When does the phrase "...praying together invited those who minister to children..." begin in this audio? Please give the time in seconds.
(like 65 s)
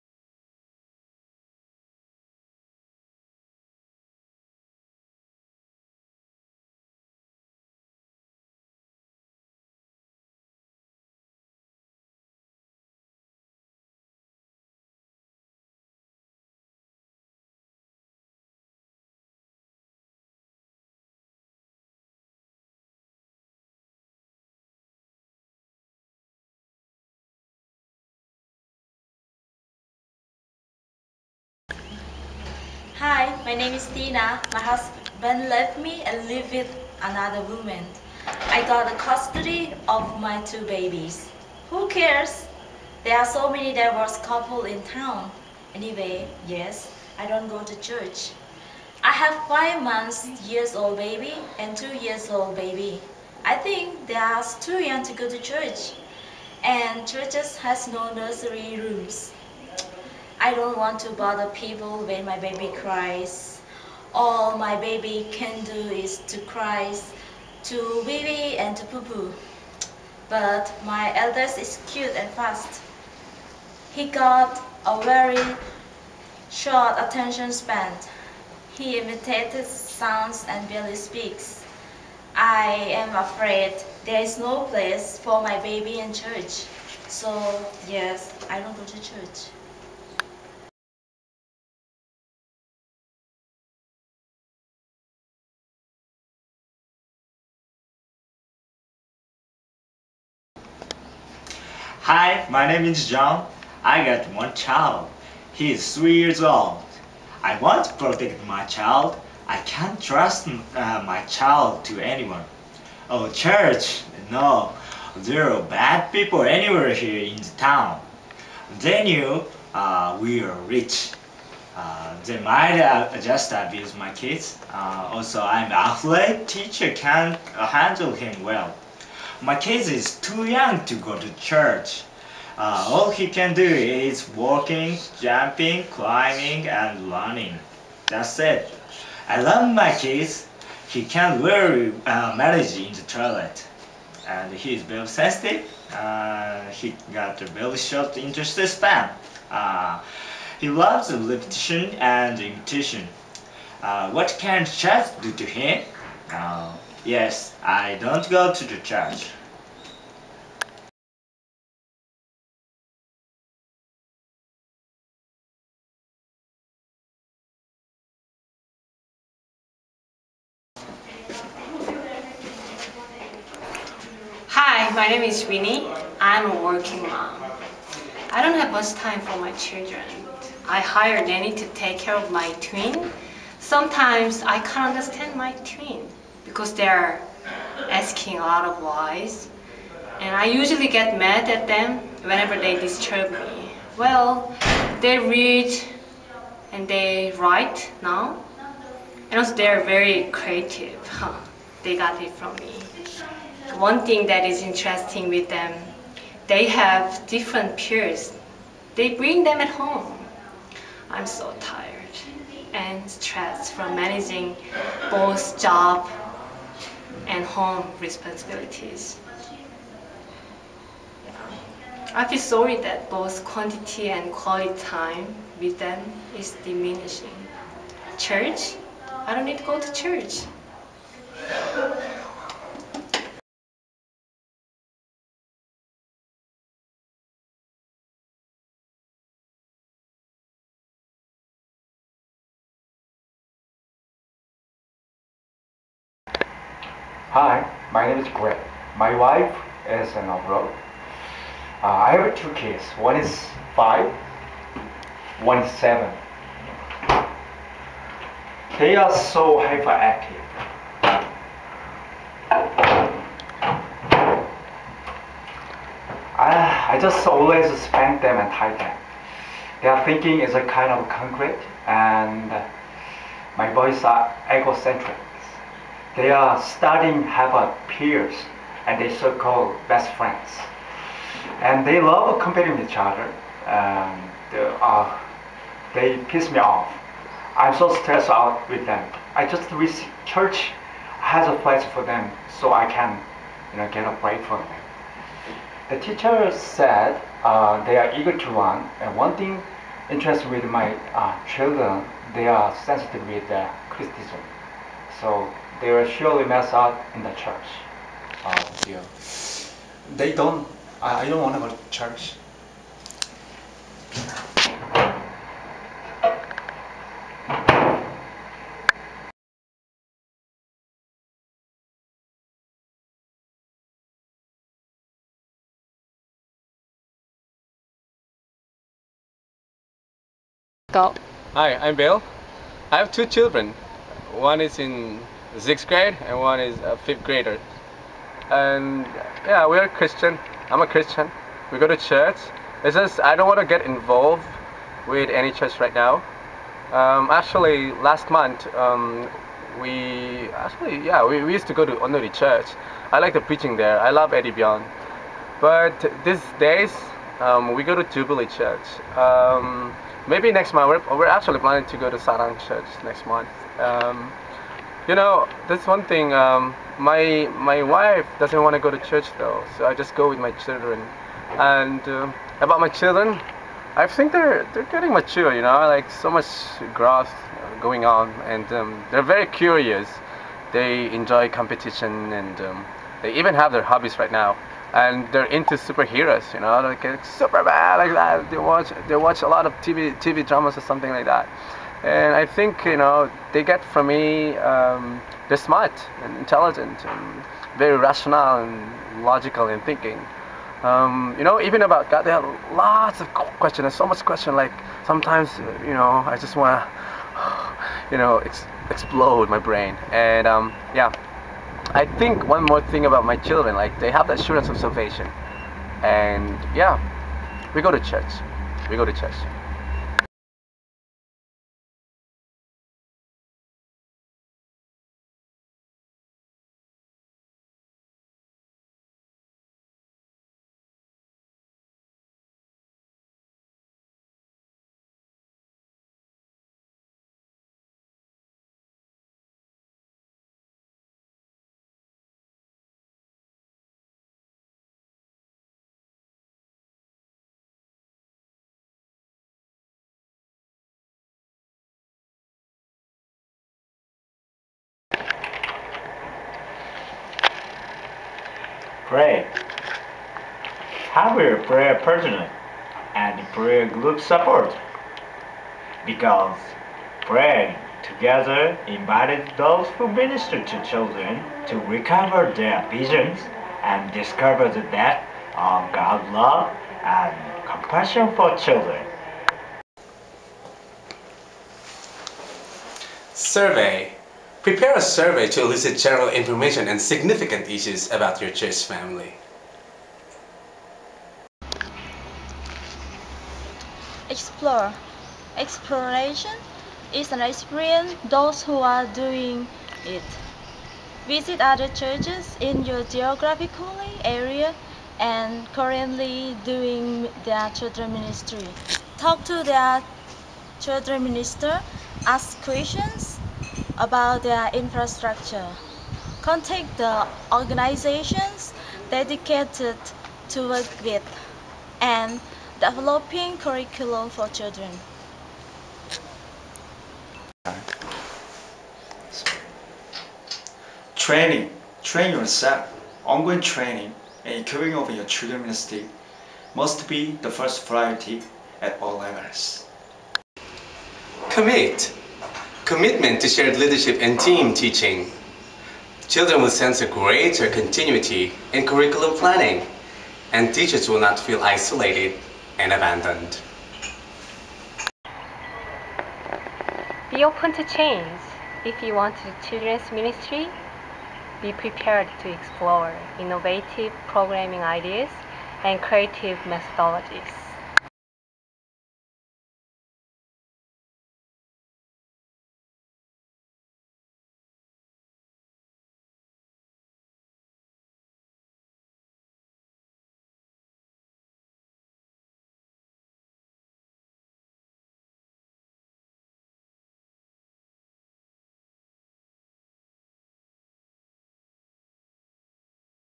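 467 s.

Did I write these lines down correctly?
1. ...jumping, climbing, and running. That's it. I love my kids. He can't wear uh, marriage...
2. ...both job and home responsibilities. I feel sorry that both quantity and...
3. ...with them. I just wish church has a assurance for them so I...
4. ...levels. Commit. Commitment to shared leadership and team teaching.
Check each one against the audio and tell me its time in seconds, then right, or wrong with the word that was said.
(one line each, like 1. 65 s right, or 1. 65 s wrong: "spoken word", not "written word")
1. 135 s right
2. 215 s right
3. 288 s wrong: "place", not "assurance"
4. 539 s right.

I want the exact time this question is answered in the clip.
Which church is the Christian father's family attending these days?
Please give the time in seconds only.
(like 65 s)
358 s.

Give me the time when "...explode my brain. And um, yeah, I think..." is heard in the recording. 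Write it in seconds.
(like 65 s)
408 s.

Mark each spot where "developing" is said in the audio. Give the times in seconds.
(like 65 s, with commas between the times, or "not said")
522 s.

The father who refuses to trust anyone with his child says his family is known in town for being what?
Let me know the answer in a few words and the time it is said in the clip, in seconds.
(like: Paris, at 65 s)
Rich, at 120 s.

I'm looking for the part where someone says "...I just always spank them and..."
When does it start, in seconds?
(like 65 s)
266 s.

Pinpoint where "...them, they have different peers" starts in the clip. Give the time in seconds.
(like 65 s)
205 s.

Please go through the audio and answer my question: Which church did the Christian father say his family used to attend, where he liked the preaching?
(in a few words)
Onnuri Church.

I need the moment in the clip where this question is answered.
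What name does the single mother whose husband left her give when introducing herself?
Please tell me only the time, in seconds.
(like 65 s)
33 s.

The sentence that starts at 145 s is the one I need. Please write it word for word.
Uh, he got a very short interest span.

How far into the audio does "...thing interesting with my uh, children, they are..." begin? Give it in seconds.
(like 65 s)
299 s.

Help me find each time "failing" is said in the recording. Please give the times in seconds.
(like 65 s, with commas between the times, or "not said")
not said.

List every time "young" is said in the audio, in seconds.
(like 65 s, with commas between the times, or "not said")
54 s, 130 s.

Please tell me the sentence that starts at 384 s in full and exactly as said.
And they're into superheroes, you know, like Superman, like that.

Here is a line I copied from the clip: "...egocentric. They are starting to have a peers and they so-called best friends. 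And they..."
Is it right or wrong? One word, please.
right.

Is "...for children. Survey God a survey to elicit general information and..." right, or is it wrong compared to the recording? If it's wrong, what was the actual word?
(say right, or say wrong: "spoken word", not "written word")
wrong: "Prepare", not "God".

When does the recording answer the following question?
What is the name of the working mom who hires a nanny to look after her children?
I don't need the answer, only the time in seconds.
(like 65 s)
175 s.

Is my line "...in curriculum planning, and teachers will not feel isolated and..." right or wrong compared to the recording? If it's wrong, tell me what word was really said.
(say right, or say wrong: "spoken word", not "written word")
right.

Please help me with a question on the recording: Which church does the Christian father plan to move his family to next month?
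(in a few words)
Sarang Church.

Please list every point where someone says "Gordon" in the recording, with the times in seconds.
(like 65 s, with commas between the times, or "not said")
not said.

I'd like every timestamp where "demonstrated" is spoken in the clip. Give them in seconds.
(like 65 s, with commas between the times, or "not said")
not said.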